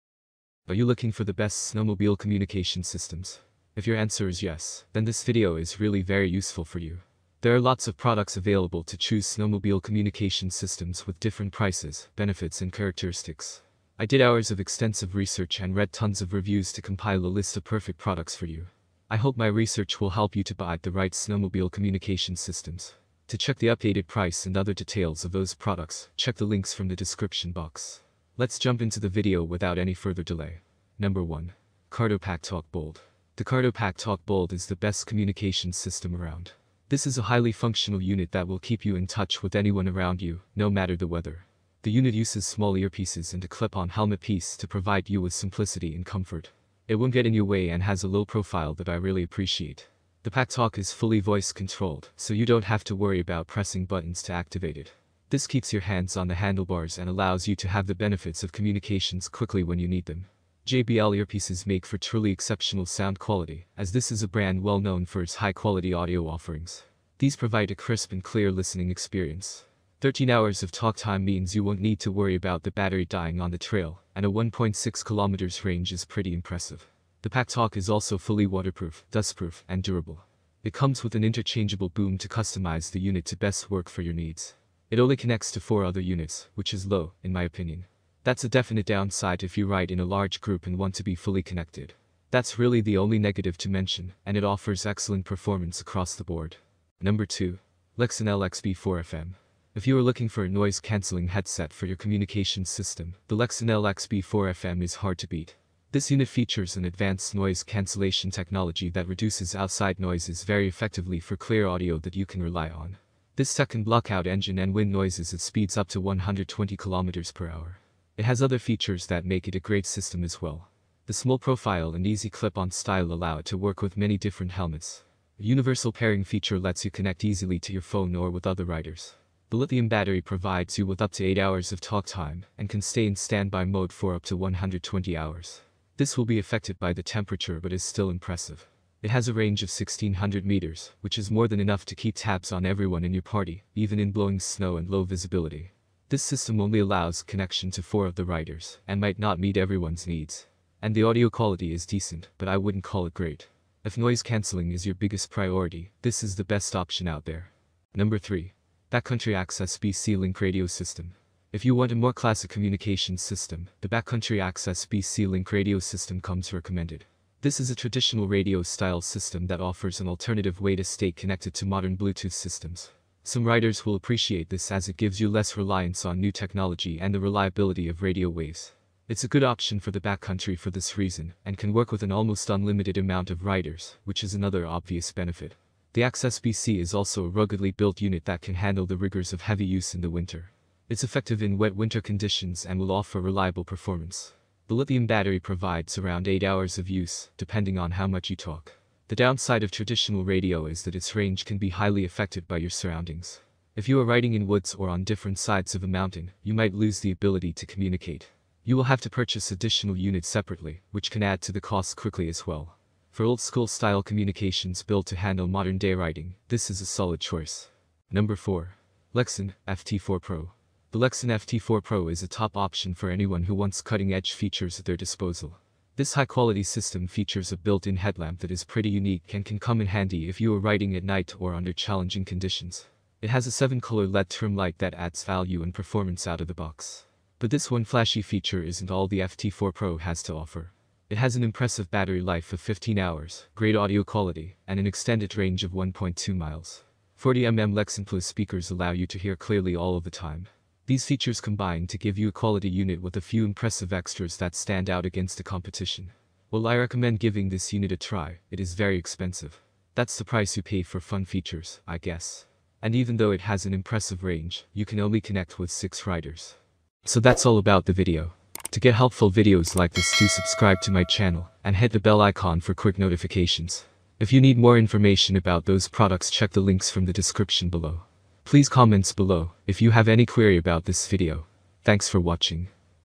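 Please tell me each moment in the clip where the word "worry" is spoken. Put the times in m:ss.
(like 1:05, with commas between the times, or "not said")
0:52, 1:12.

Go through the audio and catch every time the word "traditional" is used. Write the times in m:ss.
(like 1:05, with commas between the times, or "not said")
2:47, 3:19.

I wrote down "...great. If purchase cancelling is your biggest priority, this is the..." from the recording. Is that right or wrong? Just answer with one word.
wrong.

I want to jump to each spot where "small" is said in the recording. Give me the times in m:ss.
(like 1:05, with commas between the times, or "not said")
0:42, 2:01.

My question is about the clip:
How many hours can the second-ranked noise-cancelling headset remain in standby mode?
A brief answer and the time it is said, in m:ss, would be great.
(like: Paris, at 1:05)
120 hours, at 2:14.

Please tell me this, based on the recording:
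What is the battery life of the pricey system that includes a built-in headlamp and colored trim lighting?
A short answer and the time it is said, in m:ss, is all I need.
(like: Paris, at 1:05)
15 hours, at 4:02.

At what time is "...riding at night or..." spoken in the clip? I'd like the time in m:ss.
3:50.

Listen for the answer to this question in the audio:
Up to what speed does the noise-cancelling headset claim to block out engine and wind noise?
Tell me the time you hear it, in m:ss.
1:56.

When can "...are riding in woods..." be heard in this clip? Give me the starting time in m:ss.
3:23.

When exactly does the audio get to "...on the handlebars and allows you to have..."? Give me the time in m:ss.
0:56.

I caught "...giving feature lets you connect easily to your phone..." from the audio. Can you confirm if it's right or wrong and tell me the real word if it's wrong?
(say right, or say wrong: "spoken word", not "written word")
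wrong: "pairing", not "giving".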